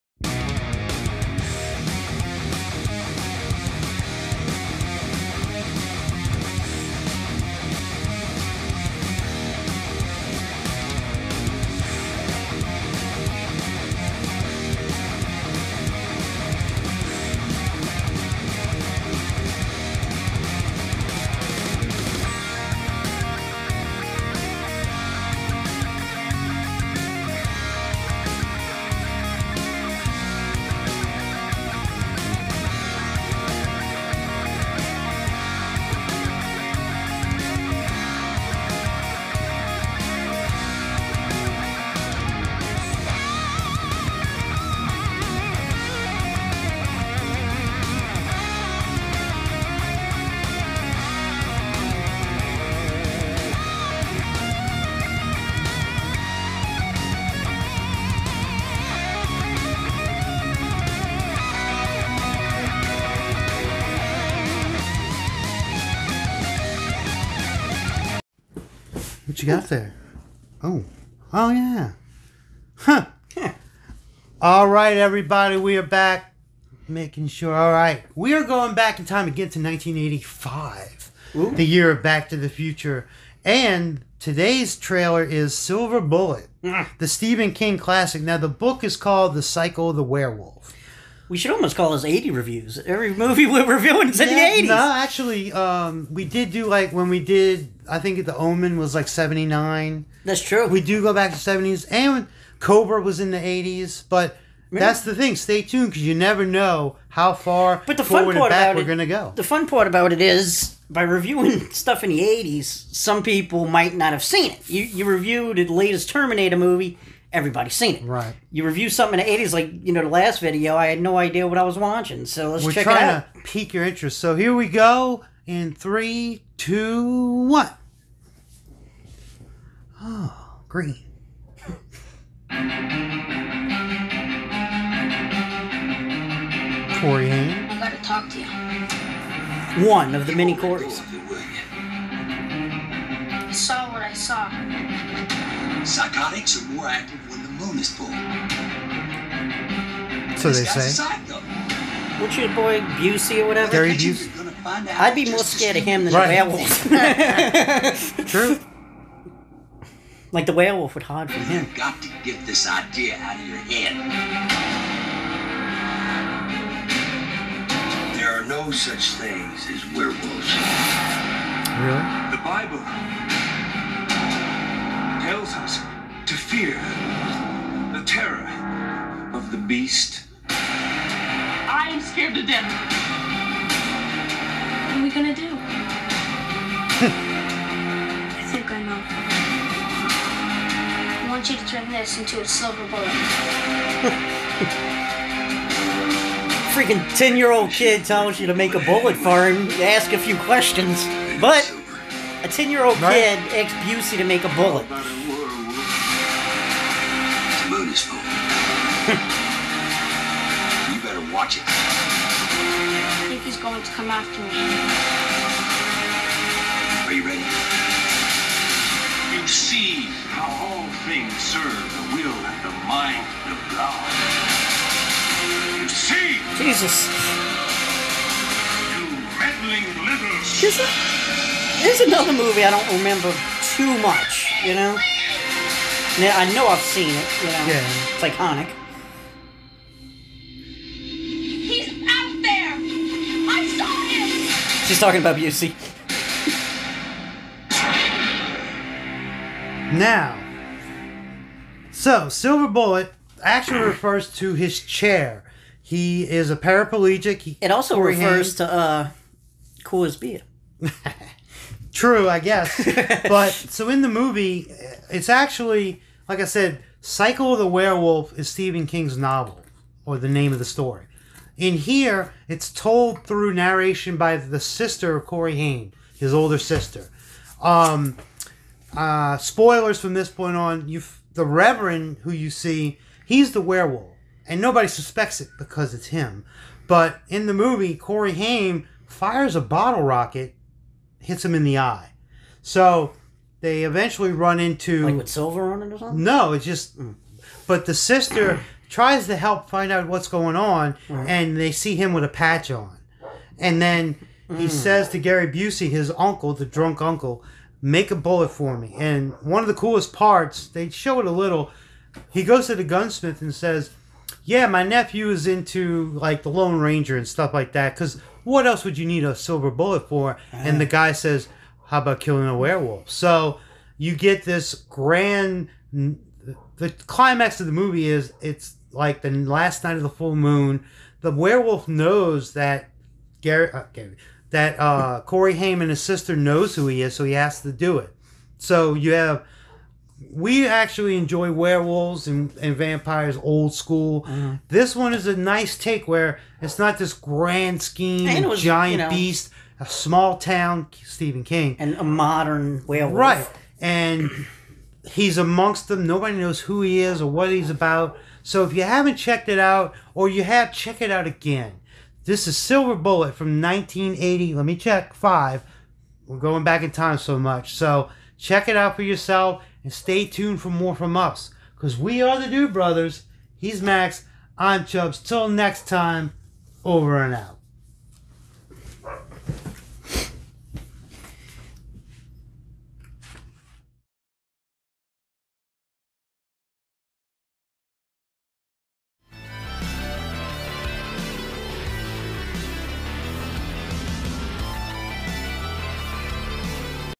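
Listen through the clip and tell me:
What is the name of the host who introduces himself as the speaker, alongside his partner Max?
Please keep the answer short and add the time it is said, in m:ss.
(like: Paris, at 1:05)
ChuBs, at 6:14.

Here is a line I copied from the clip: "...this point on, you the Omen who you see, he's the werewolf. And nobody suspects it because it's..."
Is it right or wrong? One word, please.
wrong.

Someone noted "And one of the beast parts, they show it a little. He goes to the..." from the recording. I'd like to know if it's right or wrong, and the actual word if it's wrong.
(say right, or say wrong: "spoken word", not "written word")
wrong: "coolest", not "beast".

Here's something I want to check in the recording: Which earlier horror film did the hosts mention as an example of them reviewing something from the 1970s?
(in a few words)
The Omen.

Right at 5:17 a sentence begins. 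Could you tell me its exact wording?
Because what else would you need a silver bullet for?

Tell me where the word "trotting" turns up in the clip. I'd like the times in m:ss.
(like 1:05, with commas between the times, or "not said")
not said.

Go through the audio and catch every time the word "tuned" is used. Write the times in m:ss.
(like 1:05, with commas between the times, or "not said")
1:45, 6:10.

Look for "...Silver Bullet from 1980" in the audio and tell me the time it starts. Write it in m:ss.
6:02.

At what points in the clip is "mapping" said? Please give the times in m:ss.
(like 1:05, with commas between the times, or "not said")
not said.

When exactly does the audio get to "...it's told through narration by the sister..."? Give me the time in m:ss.
4:32.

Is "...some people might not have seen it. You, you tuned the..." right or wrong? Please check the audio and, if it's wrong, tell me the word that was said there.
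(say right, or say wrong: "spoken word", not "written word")
wrong: "reviewed", not "tuned".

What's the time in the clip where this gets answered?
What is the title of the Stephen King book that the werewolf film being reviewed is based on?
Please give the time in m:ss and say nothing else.
1:29.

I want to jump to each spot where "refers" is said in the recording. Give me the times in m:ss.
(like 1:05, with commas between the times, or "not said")
4:13, 4:18.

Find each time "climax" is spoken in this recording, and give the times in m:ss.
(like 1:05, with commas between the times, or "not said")
5:27.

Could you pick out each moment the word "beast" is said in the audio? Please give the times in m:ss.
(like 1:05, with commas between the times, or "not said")
2:59, 5:49.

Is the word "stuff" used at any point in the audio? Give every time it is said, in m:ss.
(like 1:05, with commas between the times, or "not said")
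1:51, 5:17.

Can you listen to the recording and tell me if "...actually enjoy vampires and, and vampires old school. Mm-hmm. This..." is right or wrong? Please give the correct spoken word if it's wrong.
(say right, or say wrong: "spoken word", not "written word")
wrong: "werewolves", not "vampires".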